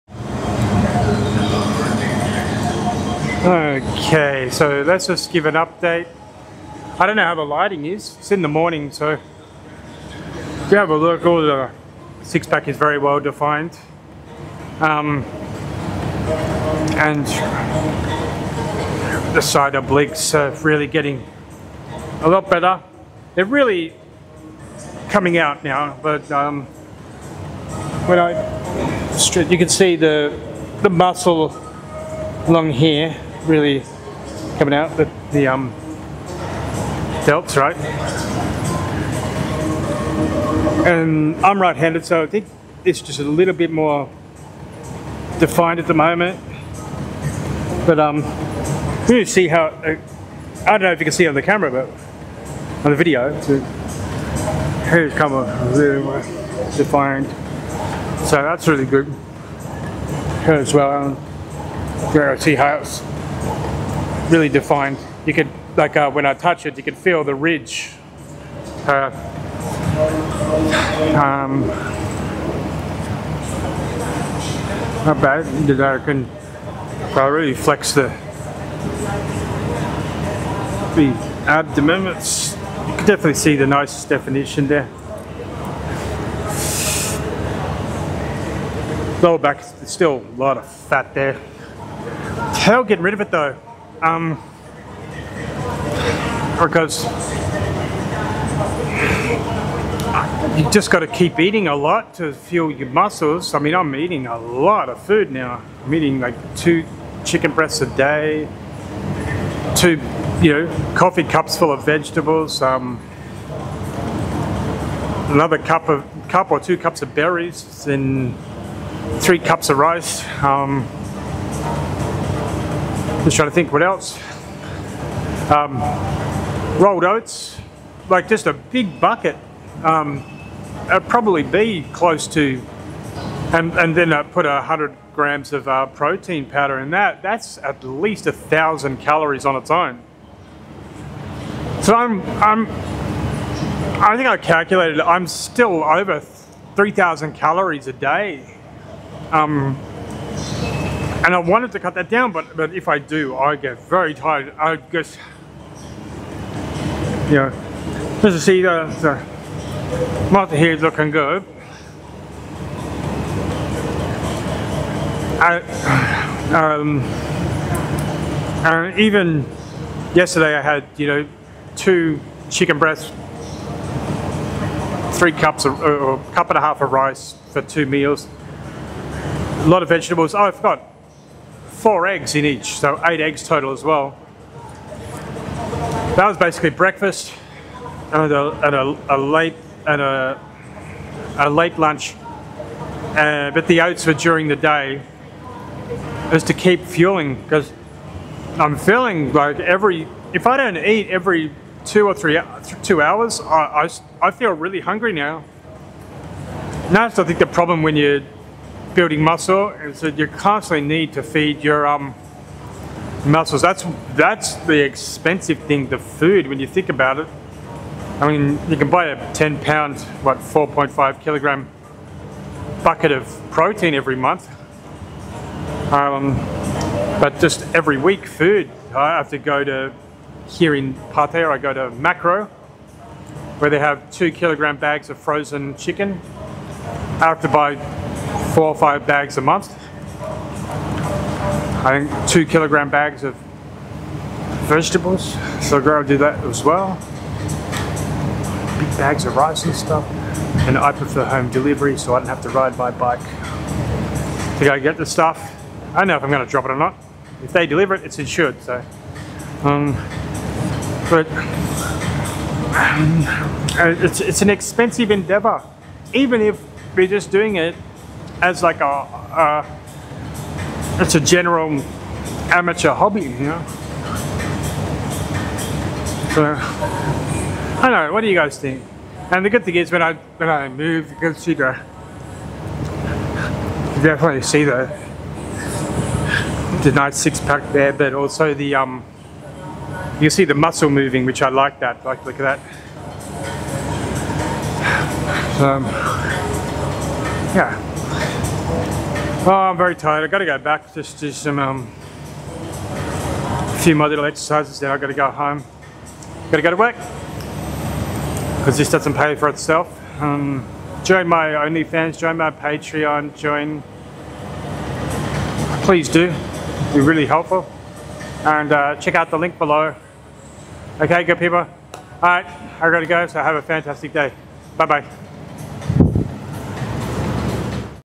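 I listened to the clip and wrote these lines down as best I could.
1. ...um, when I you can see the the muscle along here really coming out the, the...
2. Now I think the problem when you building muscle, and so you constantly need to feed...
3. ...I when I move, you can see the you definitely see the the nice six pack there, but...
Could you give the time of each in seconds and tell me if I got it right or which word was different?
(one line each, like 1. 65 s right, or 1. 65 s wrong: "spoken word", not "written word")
1. 26 s right
2. 206 s right
3. 280 s right.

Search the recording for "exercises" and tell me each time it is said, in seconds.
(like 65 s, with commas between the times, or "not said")
304 s.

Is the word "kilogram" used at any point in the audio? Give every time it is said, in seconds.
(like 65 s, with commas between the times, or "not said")
221 s, 234 s, 242 s.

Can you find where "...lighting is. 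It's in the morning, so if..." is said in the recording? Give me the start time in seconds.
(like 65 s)
7 s.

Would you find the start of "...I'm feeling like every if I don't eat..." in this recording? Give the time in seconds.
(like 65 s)
198 s.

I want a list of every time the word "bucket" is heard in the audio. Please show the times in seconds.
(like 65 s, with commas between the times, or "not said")
128 s, 222 s.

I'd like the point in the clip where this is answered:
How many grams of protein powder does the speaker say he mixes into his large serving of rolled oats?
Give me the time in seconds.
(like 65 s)
134 s.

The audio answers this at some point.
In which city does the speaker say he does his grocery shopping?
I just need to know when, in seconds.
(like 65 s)
231 s.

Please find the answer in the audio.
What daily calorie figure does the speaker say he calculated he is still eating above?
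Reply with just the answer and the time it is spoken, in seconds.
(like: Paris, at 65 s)
3,000 calories, at 146 s.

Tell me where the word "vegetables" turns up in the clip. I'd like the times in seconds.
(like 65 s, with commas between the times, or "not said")
111 s, 179 s, 244 s.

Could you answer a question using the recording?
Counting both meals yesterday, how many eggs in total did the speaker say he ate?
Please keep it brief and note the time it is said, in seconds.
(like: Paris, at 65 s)
8, at 183 s.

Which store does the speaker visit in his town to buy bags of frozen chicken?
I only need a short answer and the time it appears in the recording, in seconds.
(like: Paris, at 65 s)
Makro, at 231 s.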